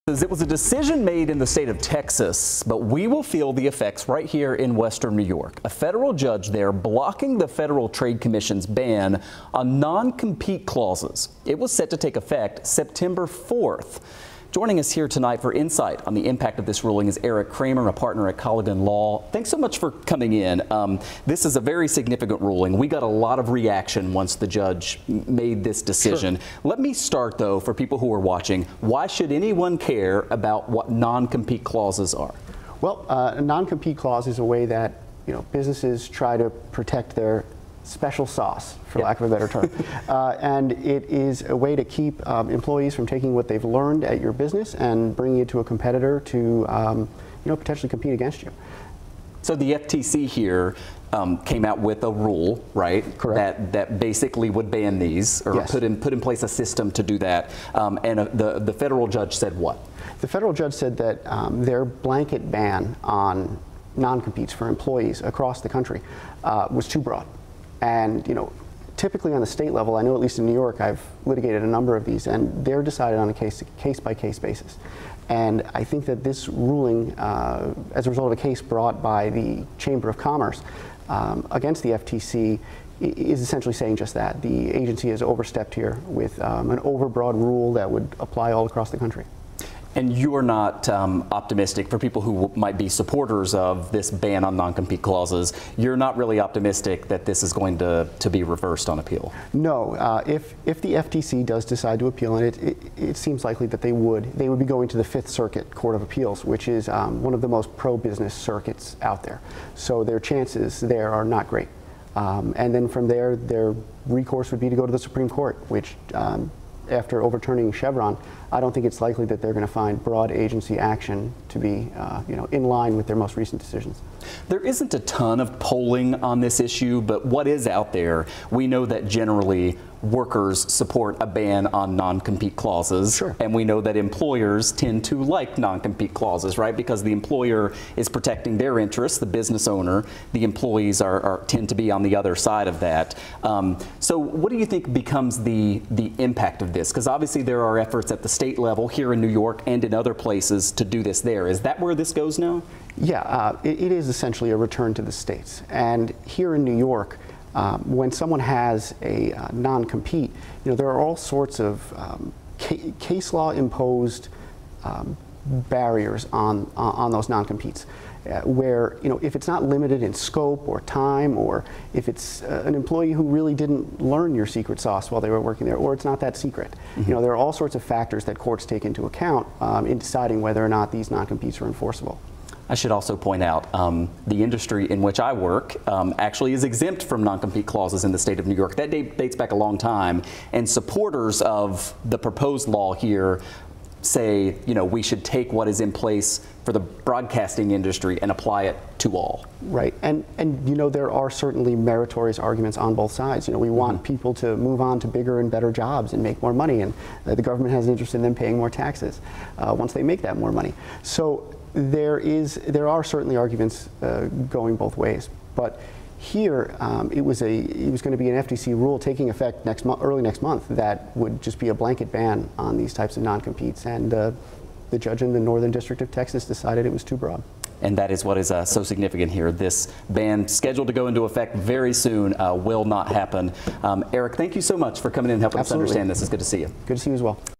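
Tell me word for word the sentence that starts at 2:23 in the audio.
Um, so what do you think becomes the, the impact of this?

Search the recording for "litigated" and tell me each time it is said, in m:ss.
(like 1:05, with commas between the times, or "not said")
1:11.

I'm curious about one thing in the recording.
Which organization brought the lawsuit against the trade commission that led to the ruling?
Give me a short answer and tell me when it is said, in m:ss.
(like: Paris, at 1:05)
Chamber of Commerce, at 1:19.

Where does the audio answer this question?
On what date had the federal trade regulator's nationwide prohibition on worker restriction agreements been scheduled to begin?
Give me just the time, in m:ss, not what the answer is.
0:12.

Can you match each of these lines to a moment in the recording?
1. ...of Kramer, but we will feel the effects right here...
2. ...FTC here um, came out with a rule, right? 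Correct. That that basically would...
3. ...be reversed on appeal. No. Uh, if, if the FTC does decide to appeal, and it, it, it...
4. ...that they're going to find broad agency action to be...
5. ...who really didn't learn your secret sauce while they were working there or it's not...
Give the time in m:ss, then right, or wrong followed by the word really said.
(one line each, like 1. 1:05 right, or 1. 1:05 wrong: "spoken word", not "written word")
1. 0:01 wrong: "Texas", not "Kramer"
2. 0:49 right
3. 1:38 right
4. 1:59 right
5. 2:53 right.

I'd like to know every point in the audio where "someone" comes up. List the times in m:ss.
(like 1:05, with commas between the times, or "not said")
2:38.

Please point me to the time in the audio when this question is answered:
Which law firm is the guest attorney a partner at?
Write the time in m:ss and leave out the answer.
0:18.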